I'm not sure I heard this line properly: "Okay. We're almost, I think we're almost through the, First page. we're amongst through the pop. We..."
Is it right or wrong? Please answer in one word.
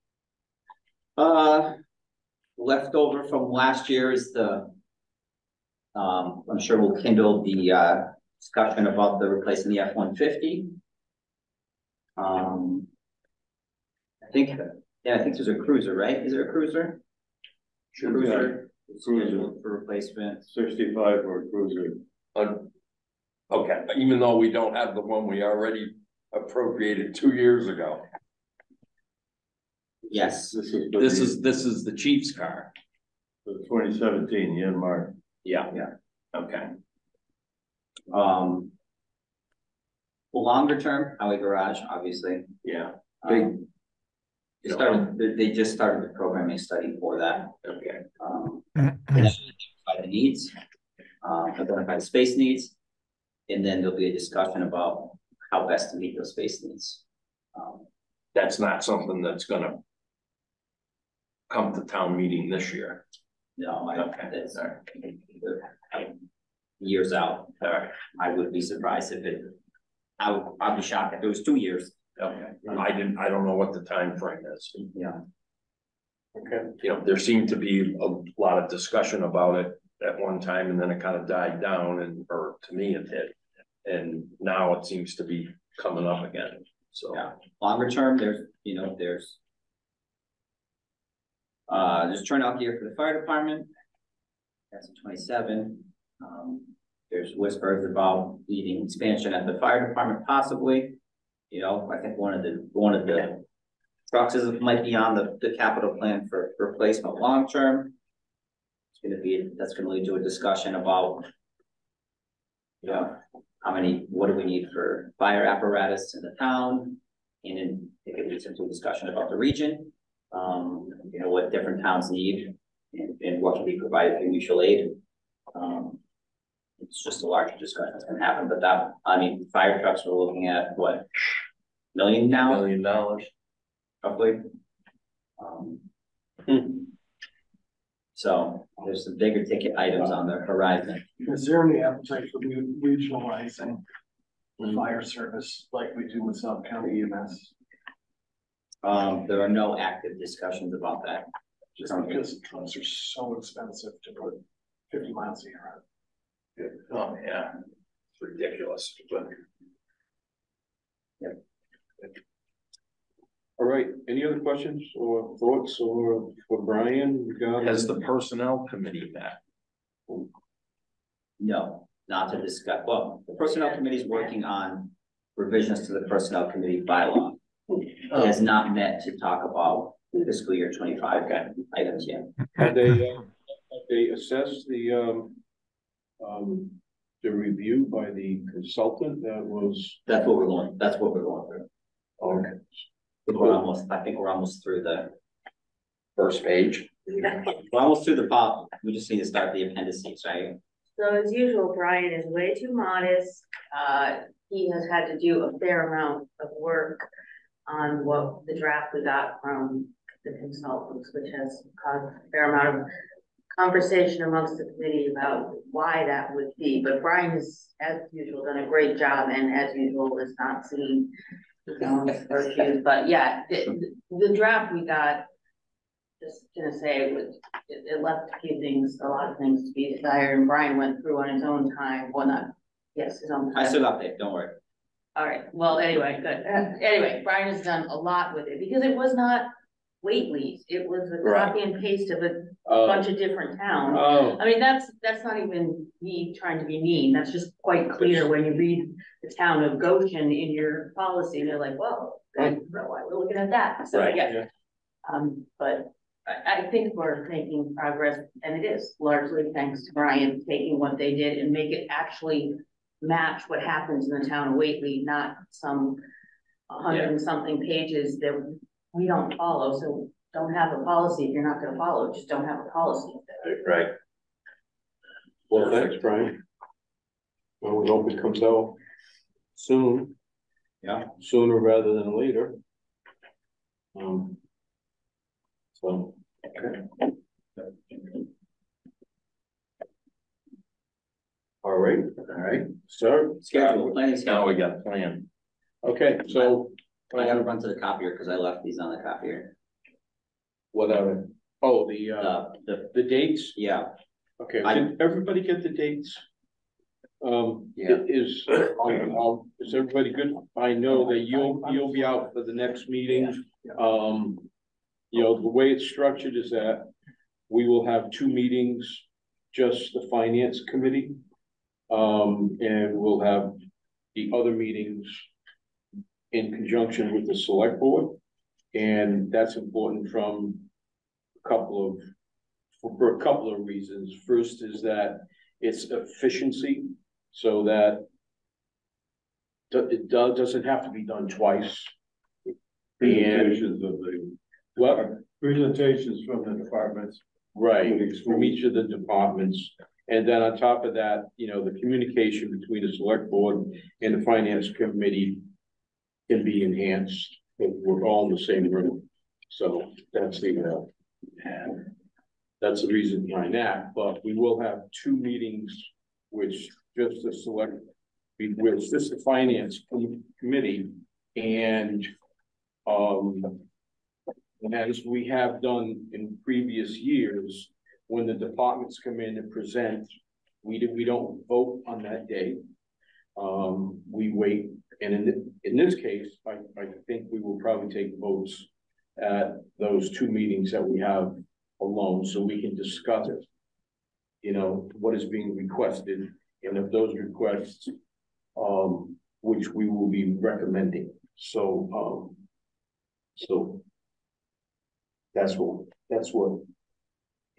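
wrong.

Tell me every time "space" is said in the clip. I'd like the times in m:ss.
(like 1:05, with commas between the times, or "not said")
0:52, 0:56.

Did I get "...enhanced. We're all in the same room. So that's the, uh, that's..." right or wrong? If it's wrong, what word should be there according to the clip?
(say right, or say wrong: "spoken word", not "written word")
right.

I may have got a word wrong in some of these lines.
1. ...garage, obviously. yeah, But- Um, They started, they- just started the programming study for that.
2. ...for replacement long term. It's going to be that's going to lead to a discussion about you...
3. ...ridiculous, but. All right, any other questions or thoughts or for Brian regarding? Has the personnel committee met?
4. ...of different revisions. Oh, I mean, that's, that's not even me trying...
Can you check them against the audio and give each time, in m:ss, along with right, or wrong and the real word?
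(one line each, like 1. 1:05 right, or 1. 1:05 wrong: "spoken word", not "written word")
1. 0:41 wrong: "Big", not "But"
2. 1:46 right
3. 2:38 right
4. 4:03 wrong: "towns", not "revisions".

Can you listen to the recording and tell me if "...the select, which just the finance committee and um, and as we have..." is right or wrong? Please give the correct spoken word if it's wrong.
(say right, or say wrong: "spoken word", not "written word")
right.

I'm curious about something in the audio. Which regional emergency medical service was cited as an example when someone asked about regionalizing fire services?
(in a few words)
South County EMS.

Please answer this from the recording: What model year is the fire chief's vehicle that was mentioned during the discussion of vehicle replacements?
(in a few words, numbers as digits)
2017.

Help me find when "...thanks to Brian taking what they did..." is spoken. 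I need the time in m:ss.
4:19.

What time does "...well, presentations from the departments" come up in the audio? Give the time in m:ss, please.
5:44.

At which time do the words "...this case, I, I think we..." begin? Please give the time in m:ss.
6:25.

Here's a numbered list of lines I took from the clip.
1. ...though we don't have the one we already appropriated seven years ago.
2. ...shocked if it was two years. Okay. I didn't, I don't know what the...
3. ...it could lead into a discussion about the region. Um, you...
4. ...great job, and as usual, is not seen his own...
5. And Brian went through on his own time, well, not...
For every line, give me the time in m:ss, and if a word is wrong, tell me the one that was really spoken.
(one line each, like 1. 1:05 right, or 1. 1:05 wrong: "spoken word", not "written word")
1. 0:24 wrong: "two", not "seven"
2. 1:10 right
3. 1:58 right
4. 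3:38 right
5. 3:50 right.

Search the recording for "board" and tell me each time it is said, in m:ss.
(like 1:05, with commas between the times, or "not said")
5:27, 5:53.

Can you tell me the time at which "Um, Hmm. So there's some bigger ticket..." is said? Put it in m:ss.
2:15.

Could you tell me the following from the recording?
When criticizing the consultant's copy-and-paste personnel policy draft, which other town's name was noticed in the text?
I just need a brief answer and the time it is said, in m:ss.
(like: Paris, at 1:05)
Goshen, at 4:09.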